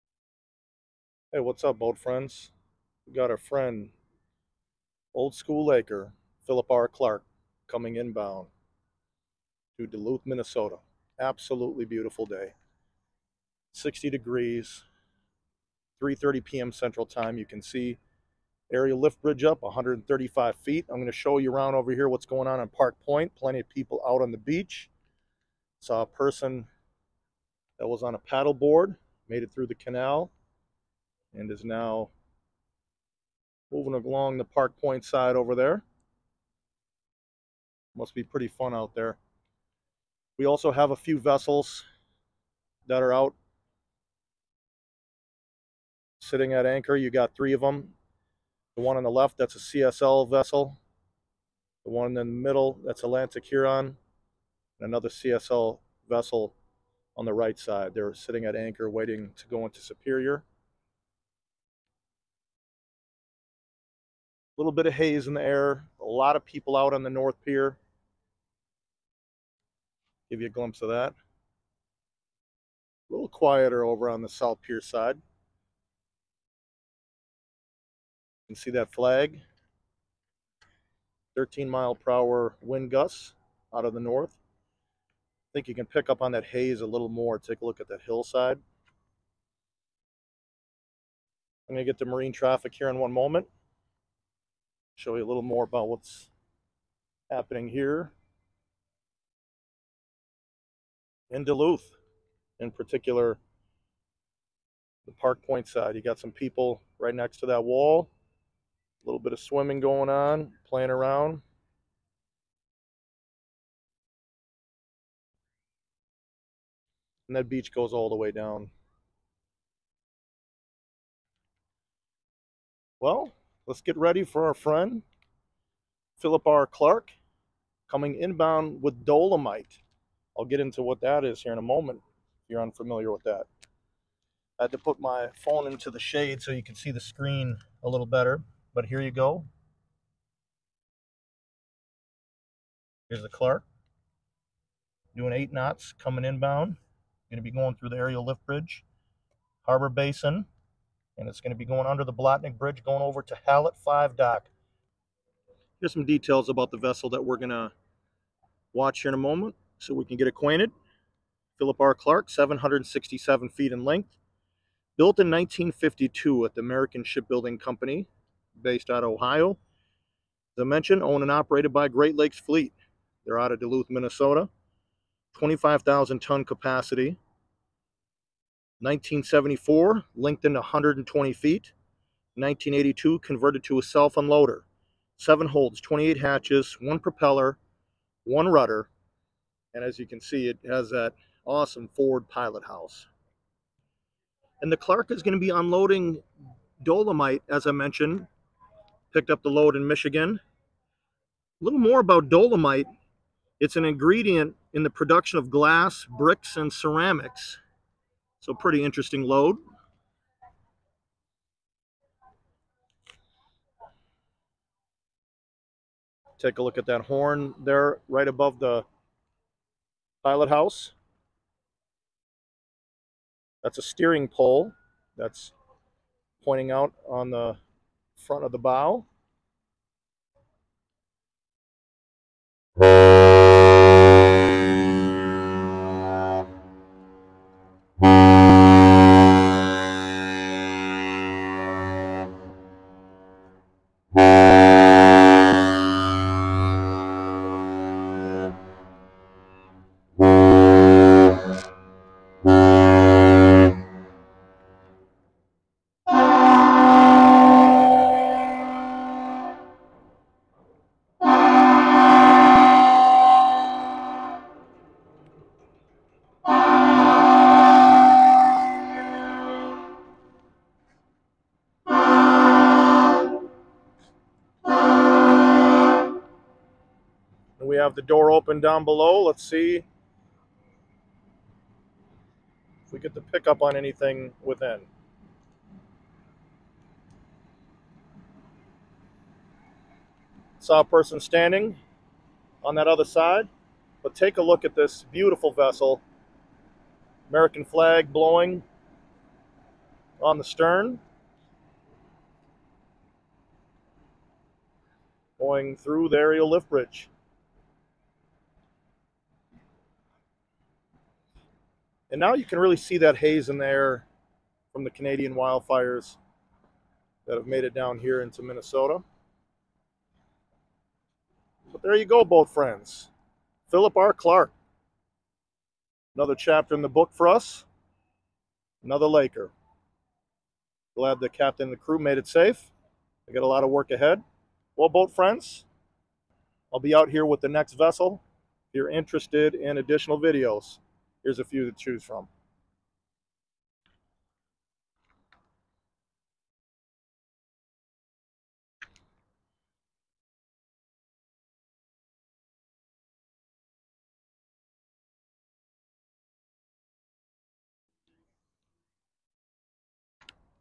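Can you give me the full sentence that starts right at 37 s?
Must be pretty fun out there.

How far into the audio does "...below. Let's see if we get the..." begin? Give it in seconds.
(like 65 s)
278 s.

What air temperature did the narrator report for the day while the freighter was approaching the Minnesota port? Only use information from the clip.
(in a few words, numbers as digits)
60 degrees.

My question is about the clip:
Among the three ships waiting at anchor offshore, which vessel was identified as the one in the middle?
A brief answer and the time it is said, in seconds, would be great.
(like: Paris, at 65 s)
Atlantic Huron, at 53 s.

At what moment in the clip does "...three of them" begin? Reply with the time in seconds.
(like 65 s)
47 s.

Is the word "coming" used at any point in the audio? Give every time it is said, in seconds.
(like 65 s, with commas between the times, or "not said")
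7 s, 127 s, 145 s.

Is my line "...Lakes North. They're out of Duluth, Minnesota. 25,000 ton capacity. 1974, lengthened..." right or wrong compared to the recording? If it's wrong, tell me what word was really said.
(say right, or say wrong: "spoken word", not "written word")
wrong: "Fleet", not "North".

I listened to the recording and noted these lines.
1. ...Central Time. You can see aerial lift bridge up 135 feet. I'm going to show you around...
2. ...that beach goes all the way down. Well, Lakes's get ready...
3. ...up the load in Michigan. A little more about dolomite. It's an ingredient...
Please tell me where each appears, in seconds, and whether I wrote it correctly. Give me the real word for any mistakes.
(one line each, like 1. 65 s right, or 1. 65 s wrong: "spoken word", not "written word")
1. 16 s right
2. 117 s wrong: "Let", not "Lakes"
3. 199 s right.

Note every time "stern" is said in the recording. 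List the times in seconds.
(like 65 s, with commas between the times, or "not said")
300 s.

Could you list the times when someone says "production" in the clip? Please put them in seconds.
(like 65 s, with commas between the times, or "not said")
204 s.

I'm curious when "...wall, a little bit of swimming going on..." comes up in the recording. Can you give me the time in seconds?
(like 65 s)
107 s.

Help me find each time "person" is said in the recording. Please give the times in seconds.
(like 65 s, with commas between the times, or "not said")
26 s, 290 s.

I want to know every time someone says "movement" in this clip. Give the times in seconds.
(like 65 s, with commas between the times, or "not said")
not said.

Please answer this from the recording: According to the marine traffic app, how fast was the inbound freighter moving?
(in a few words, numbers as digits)
8 knots.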